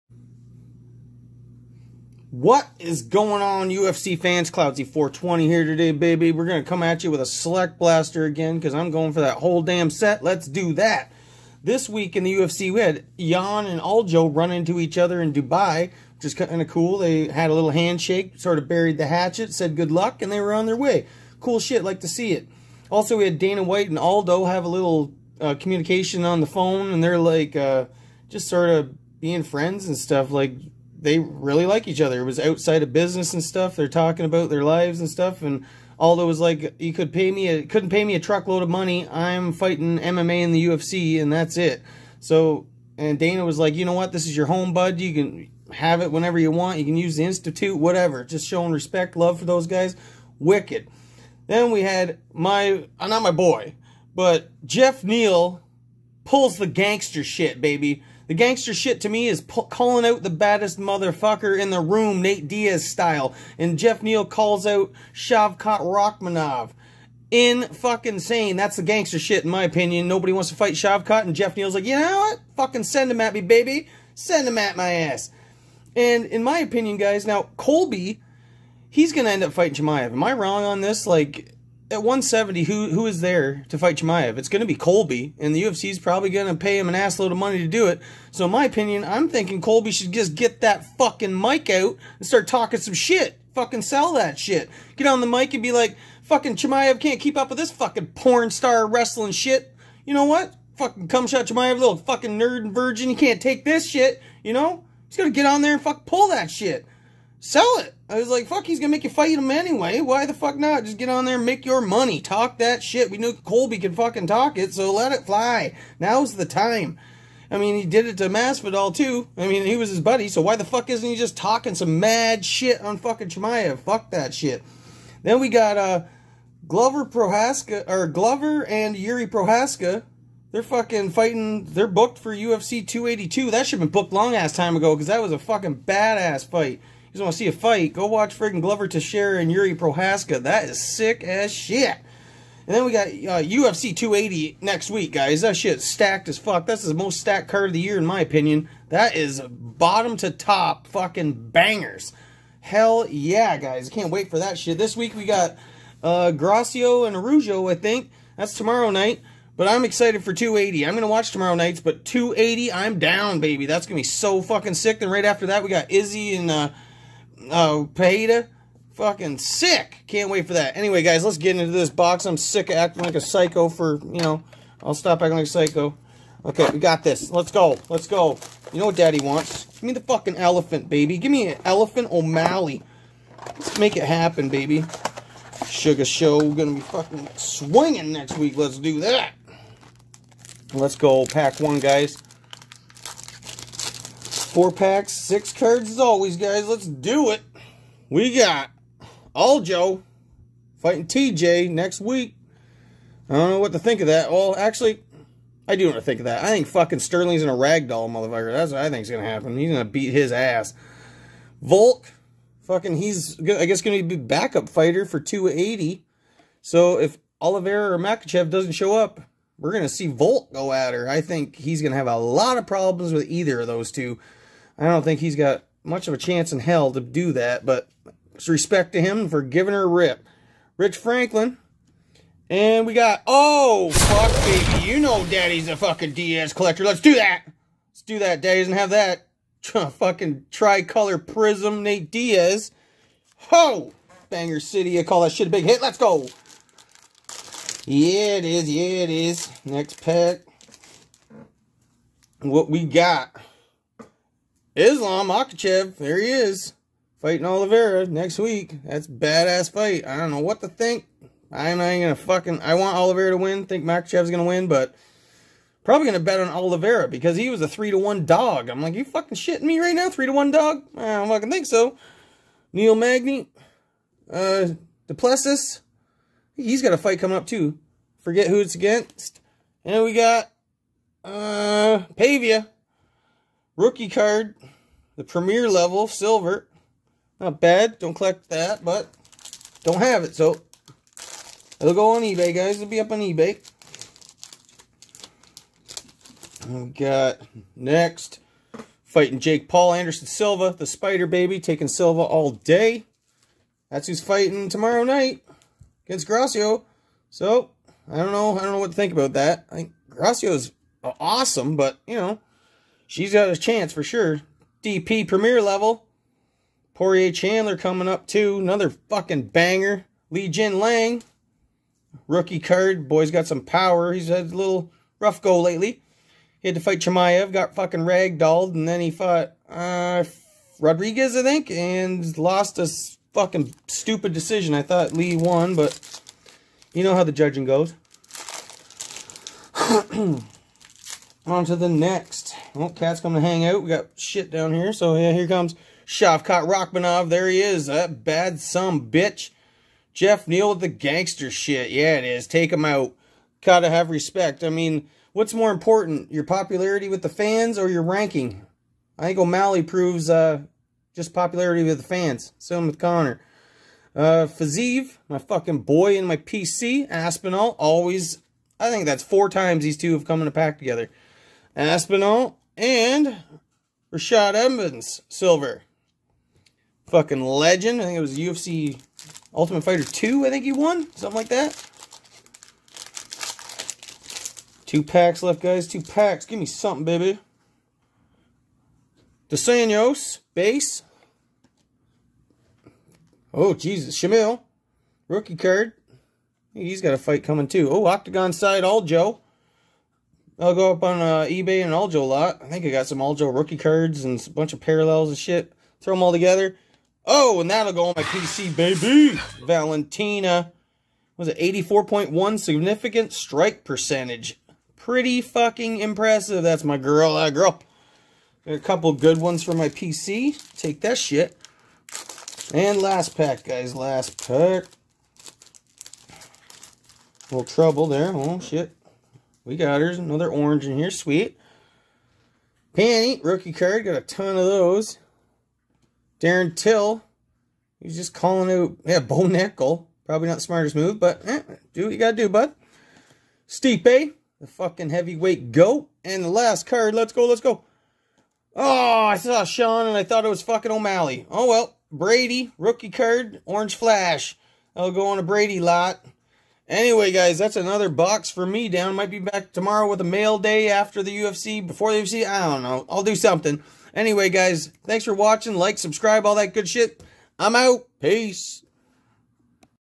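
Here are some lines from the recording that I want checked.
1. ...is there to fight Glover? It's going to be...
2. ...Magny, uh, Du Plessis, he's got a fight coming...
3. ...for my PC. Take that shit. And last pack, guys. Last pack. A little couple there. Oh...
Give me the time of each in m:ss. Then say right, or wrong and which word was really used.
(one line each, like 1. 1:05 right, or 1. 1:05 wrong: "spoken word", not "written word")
1. 1:23 wrong: "Chimaev", not "Glover"
2. 4:32 right
3. 6:59 wrong: "trouble", not "couple".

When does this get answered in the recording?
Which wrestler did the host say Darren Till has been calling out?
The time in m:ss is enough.
7:19.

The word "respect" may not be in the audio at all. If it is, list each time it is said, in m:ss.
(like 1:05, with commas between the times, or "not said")
0:48, 3:48, 5:54.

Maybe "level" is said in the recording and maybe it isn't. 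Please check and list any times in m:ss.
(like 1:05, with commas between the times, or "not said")
4:45, 5:15.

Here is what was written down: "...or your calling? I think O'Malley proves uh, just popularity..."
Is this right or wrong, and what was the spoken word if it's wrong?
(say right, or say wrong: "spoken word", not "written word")
wrong: "ranking", not "calling".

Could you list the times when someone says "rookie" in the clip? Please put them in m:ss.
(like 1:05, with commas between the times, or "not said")
4:43, 5:22, 6:35, 6:43, 7:13, 7:32.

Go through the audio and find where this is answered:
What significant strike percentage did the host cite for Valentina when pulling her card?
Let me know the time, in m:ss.
6:51.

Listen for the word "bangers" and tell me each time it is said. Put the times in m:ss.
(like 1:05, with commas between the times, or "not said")
2:31, 4:04, 5:19.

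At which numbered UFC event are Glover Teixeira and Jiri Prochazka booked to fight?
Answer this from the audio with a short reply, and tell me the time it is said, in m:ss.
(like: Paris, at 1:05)
UFC 282, at 2:12.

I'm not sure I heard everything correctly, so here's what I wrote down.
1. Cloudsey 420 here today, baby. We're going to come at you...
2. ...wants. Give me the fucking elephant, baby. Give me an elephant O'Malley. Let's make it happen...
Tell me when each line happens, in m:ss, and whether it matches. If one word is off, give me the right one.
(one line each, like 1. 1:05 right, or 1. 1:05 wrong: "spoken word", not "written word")
1. 0:04 right
2. 2:59 right.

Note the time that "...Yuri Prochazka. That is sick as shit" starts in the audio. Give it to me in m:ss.
2:19.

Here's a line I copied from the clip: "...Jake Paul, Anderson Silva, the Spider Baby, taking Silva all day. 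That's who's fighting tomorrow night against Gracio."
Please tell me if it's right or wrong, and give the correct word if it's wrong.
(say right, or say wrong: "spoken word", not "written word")
right.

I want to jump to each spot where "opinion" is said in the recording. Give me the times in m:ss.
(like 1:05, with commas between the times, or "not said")
1:09, 1:16, 1:28, 2:28.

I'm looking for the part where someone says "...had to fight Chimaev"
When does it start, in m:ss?
5:26.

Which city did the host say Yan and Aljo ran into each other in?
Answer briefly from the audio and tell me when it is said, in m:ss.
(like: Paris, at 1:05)
Dubai, at 0:15.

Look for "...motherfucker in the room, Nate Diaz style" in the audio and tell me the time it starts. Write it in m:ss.
1:00.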